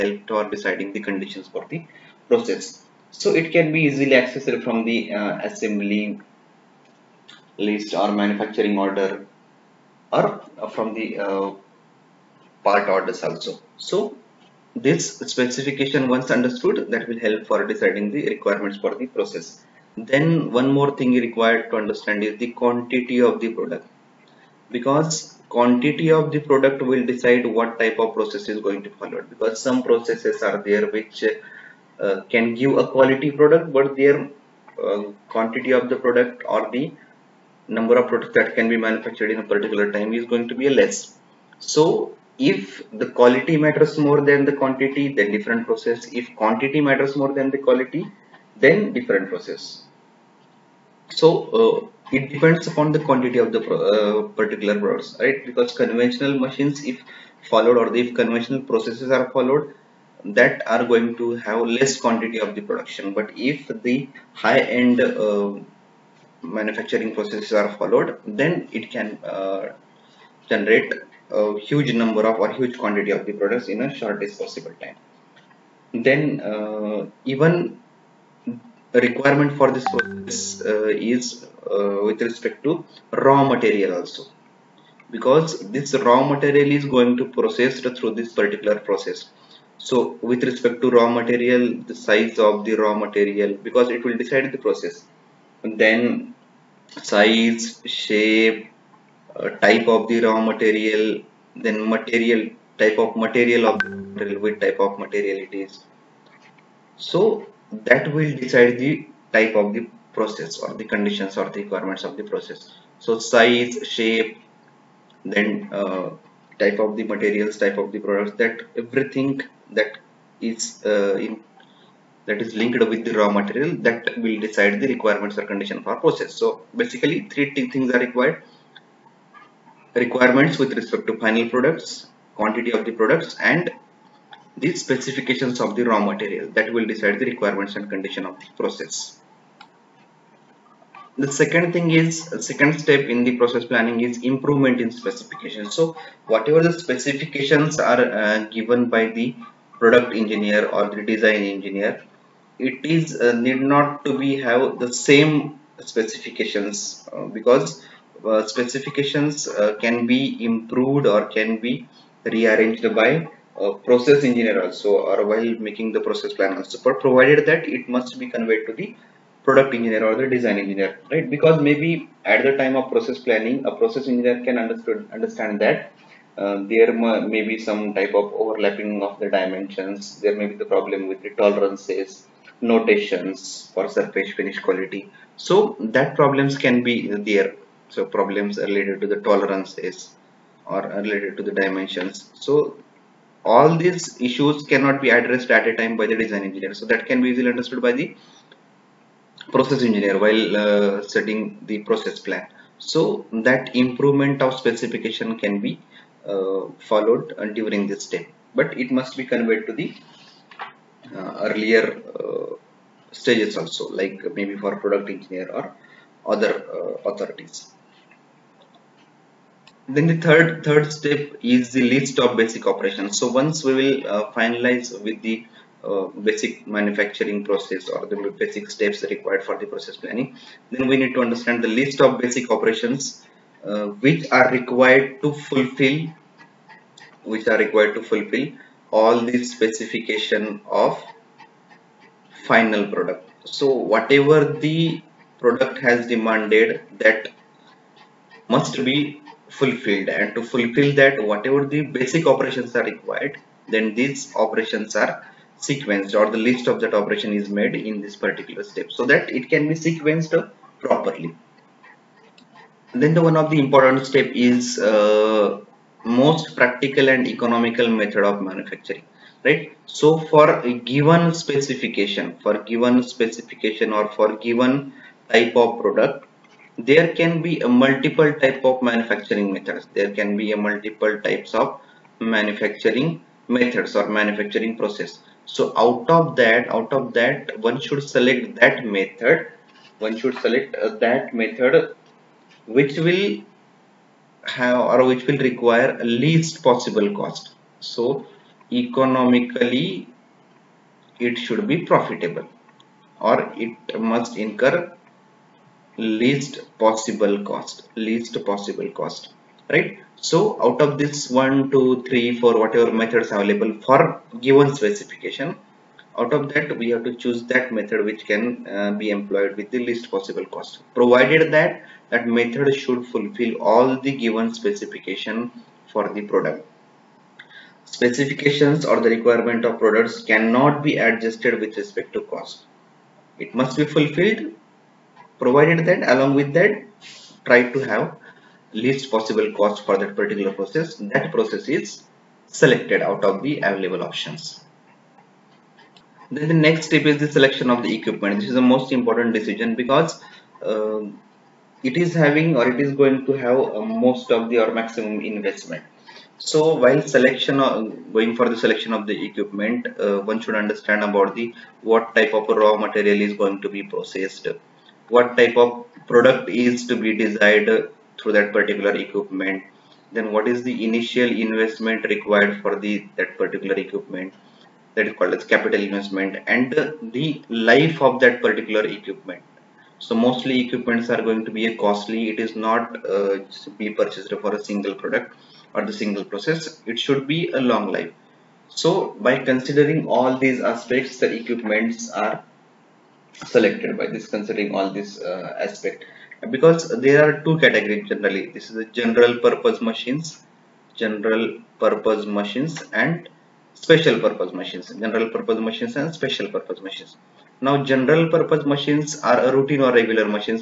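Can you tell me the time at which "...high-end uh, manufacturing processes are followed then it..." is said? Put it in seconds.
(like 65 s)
64 s.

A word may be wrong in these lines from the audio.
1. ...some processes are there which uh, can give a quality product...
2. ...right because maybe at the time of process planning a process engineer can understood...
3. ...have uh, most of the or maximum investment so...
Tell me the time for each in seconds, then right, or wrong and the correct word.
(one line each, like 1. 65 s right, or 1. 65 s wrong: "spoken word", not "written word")
1. 29 s right
2. 171 s right
3. 353 s right.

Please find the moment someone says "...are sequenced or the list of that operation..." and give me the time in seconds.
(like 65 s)
255 s.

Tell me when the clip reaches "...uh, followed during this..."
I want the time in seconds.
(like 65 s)
206 s.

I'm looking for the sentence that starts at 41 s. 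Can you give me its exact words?
So if the quality matters more than the quantity, then different process.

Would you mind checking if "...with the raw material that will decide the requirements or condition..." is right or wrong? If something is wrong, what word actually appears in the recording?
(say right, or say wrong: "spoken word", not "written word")
right.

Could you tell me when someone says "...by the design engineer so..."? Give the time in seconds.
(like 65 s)
195 s.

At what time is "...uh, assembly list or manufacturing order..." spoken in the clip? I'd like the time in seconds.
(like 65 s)
5 s.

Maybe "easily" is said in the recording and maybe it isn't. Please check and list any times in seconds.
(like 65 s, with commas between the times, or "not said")
3 s, 197 s.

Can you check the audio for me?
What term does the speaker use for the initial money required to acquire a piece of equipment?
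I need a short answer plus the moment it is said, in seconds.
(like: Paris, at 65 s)
Capital investment, at 375 s.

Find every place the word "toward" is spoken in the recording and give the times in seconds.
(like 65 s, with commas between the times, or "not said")
0 s.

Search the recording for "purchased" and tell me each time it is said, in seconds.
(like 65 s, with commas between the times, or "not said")
383 s.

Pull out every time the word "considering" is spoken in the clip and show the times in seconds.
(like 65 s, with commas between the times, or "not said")
389 s, 394 s.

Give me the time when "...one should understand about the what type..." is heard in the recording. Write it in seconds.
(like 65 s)
360 s.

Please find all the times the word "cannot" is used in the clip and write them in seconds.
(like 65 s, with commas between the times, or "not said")
194 s, 330 s.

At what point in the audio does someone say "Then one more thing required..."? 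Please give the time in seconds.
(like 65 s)
20 s.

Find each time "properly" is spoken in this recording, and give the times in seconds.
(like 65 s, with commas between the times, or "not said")
260 s.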